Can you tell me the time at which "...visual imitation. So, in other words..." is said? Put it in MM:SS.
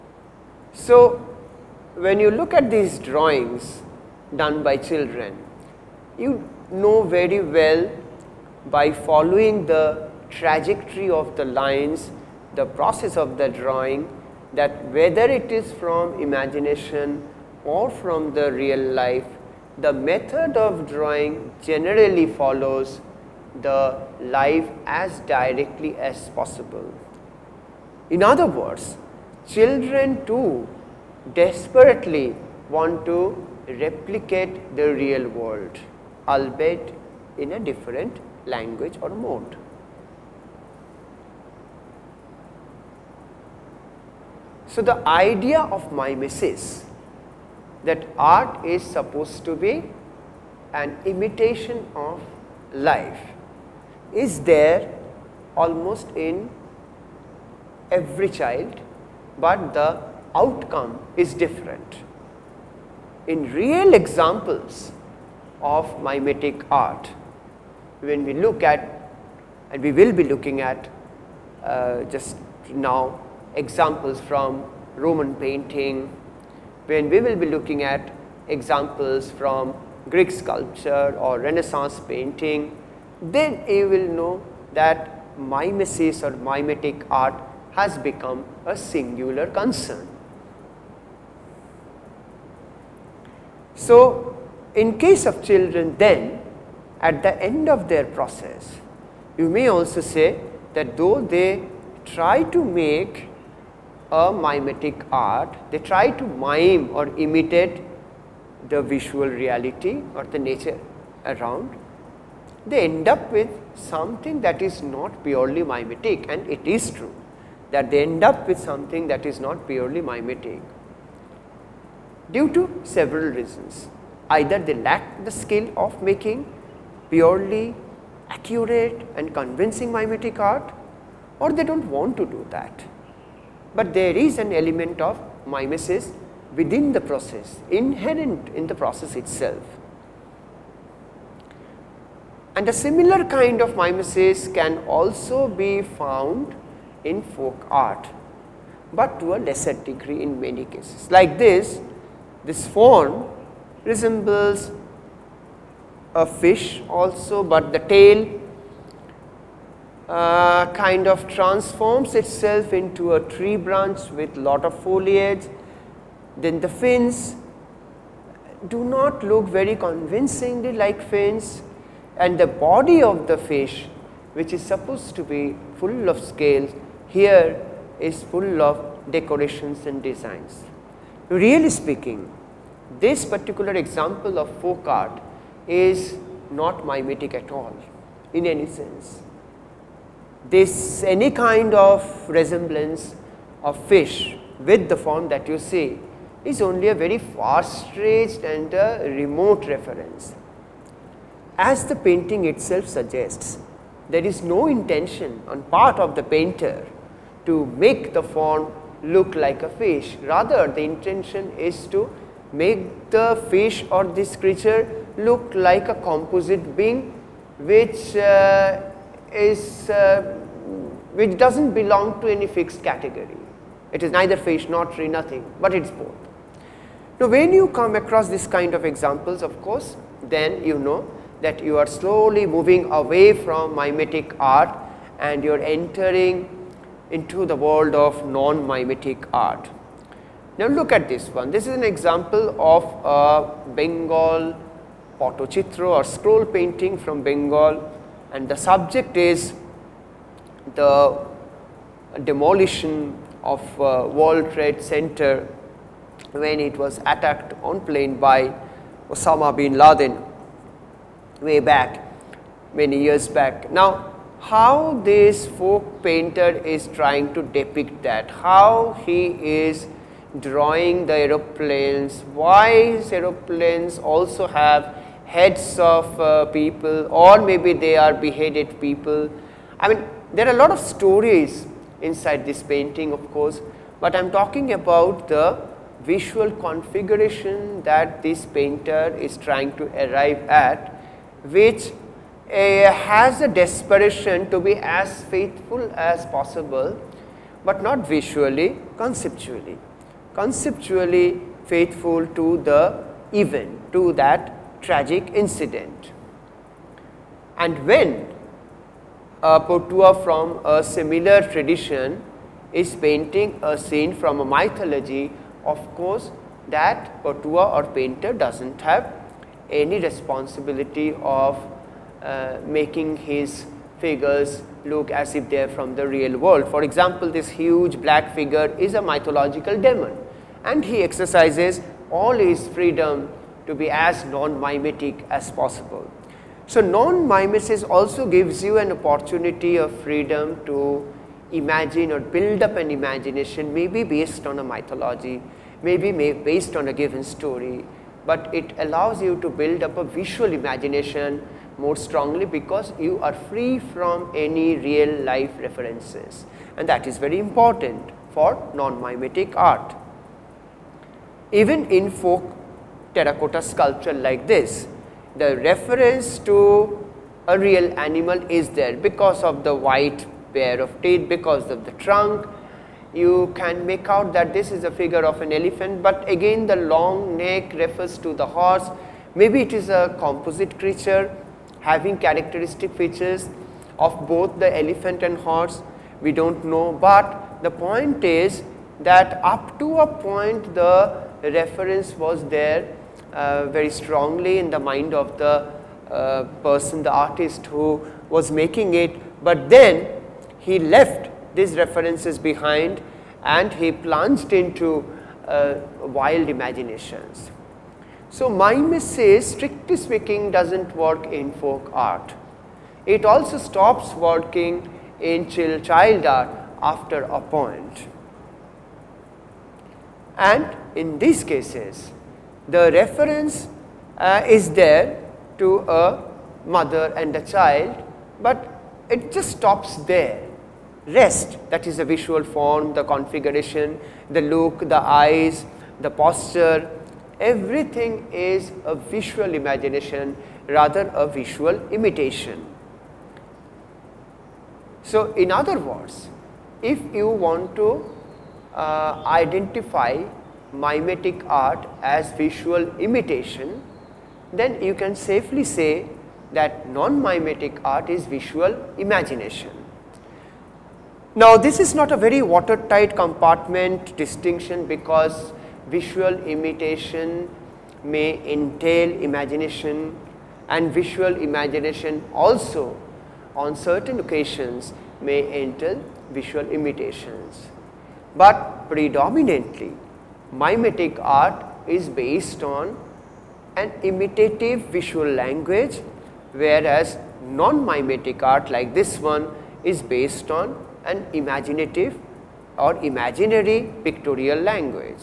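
07:21.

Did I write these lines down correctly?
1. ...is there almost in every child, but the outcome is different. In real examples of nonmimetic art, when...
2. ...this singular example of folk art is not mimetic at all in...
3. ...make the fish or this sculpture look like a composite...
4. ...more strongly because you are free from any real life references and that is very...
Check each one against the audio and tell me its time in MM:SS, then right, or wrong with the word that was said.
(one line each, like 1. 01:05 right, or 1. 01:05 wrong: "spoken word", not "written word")
1. 00:54 wrong: "mimetic", not "nonmimetic"
2. 03:02 wrong: "particular", not "singular"
3. 03:32 wrong: "creature", not "sculpture"
4. 05:51 right.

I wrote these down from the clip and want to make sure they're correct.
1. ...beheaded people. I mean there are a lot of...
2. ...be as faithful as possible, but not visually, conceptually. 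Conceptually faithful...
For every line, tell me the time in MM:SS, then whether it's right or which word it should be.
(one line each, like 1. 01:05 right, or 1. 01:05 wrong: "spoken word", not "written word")
1. 04:38 right
2. 04:54 right.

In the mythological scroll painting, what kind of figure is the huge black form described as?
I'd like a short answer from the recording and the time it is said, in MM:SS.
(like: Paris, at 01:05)
A mythological demon, at 05:29.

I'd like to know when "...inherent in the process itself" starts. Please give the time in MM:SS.
02:17.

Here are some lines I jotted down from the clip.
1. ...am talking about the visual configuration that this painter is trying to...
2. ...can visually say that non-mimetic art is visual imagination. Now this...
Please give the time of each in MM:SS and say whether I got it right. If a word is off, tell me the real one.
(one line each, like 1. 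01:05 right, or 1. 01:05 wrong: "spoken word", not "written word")
1. 04:44 right
2. 07:34 wrong: "safely", not "visually".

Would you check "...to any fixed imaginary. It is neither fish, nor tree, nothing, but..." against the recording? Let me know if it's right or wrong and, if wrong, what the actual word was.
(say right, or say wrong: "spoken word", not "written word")
wrong: "category", not "imaginary".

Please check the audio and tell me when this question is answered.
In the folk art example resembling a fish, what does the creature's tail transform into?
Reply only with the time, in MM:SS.
02:43.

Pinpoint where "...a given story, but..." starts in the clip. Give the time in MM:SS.
05:46.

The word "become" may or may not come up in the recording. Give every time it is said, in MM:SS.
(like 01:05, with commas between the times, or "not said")
01:27.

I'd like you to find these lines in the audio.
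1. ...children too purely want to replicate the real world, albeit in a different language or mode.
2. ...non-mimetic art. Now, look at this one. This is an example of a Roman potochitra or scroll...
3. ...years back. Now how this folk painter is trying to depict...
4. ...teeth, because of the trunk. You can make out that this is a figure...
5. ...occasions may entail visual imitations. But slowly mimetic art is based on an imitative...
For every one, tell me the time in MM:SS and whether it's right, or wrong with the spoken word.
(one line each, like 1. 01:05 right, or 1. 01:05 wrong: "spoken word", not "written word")
1. 00:29 wrong: "desperately", not "purely"
2. 03:58 wrong: "Bengal", not "Roman"
3. 04:23 right
4. 06:11 right
5. 07:54 wrong: "predominantly", not "slowly".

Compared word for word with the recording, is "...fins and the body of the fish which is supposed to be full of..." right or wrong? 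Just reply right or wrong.
right.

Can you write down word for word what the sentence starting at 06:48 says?
So, mimesis strictly speaking does not work in folk art.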